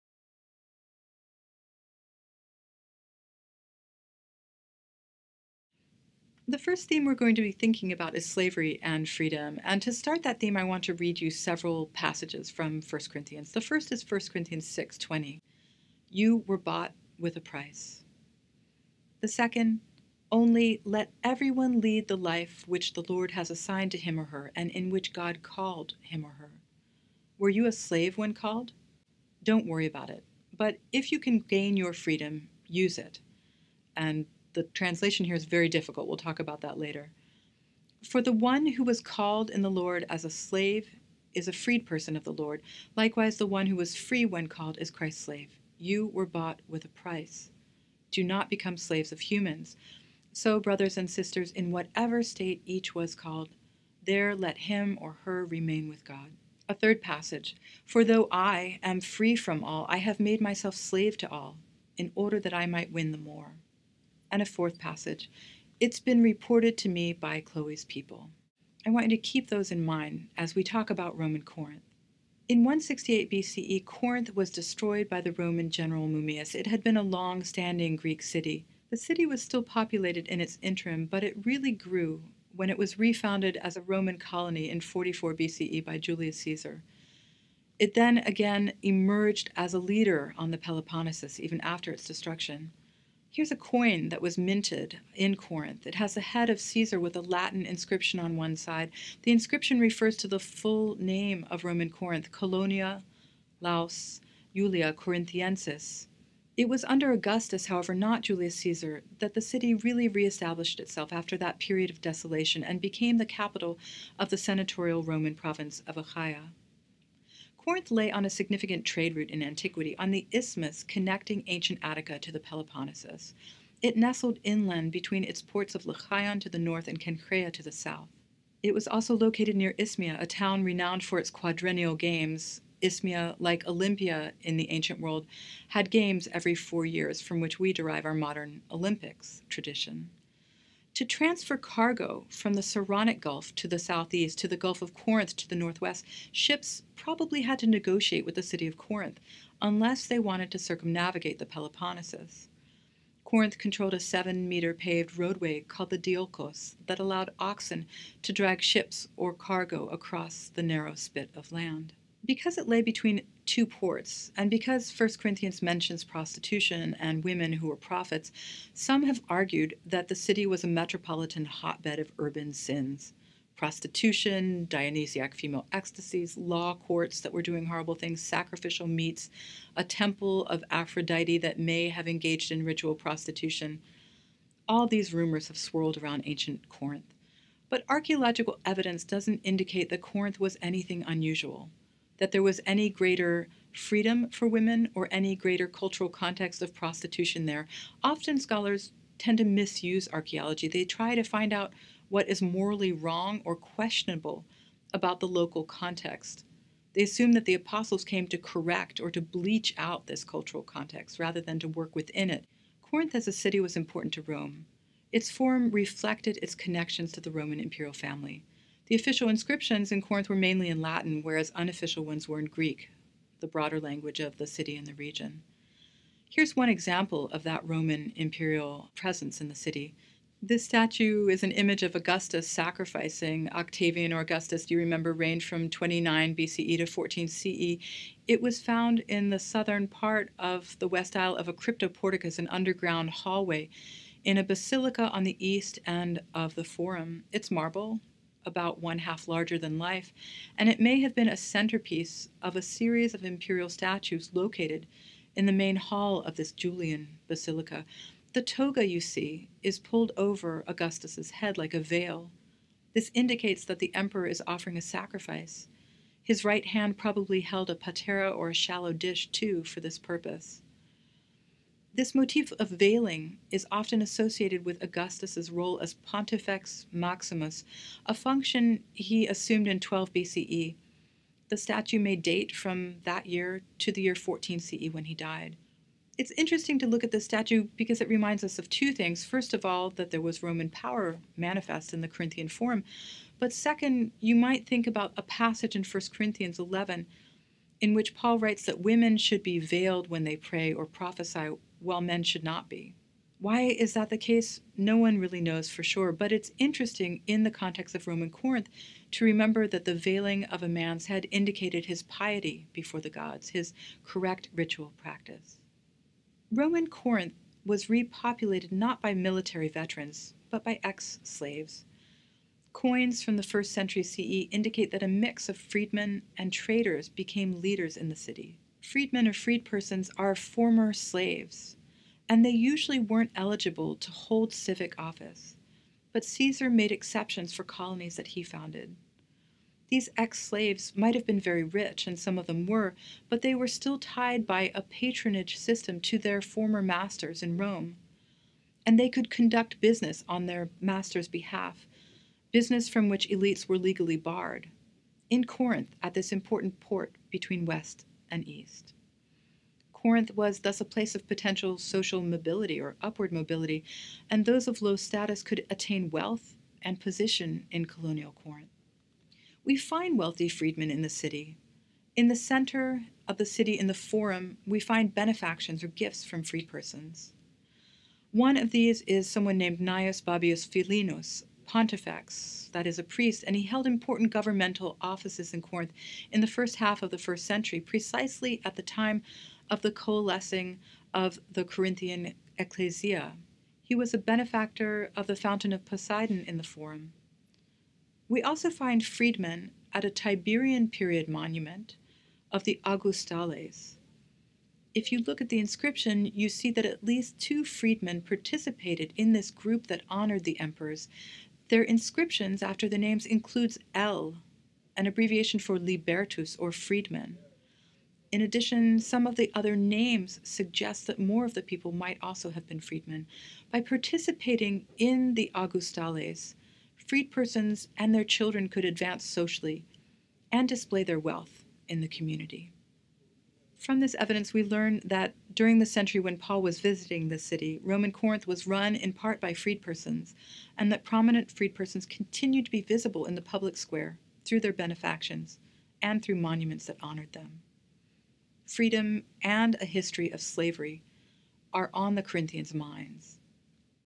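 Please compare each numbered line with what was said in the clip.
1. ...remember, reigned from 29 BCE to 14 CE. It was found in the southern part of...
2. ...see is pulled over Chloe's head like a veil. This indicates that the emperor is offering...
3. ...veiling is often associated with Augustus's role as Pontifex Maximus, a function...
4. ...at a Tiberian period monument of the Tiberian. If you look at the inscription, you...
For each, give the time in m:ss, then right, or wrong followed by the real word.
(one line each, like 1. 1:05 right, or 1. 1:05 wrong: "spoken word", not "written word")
1. 3:54 right
2. 4:19 wrong: "Augustus", not "Chloe"
3. 4:32 right
4. 6:39 wrong: "Augustales", not "Tiberian".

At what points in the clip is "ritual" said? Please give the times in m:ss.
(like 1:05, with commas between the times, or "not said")
3:02, 5:14.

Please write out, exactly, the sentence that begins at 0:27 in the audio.
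Were you a slave when called?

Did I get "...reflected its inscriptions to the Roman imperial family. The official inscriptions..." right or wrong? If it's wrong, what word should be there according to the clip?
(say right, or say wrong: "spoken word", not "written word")
wrong: "connections", not "inscriptions".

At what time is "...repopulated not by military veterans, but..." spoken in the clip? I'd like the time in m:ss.
5:17.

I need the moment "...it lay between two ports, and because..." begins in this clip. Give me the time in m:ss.
2:42.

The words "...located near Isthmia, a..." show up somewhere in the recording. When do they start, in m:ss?
2:09.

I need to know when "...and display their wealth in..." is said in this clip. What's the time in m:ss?
7:10.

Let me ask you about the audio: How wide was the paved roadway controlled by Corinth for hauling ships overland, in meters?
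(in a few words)
7.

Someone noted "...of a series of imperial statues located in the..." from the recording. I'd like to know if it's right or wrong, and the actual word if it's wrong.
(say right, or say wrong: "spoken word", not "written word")
right.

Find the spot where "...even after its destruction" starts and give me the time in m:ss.
1:31.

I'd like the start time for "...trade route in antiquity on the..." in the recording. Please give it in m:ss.
1:58.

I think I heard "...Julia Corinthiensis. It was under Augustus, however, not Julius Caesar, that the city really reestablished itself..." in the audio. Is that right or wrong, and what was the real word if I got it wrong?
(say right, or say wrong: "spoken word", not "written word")
right.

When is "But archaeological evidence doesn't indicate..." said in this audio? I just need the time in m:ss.
3:07.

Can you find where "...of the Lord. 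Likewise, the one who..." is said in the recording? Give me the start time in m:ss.
0:42.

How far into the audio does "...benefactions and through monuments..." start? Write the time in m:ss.
7:24.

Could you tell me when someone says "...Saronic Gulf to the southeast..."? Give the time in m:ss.
2:22.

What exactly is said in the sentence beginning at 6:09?
We find wealthy freedmen in the city.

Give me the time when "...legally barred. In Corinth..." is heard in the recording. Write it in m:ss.
5:53.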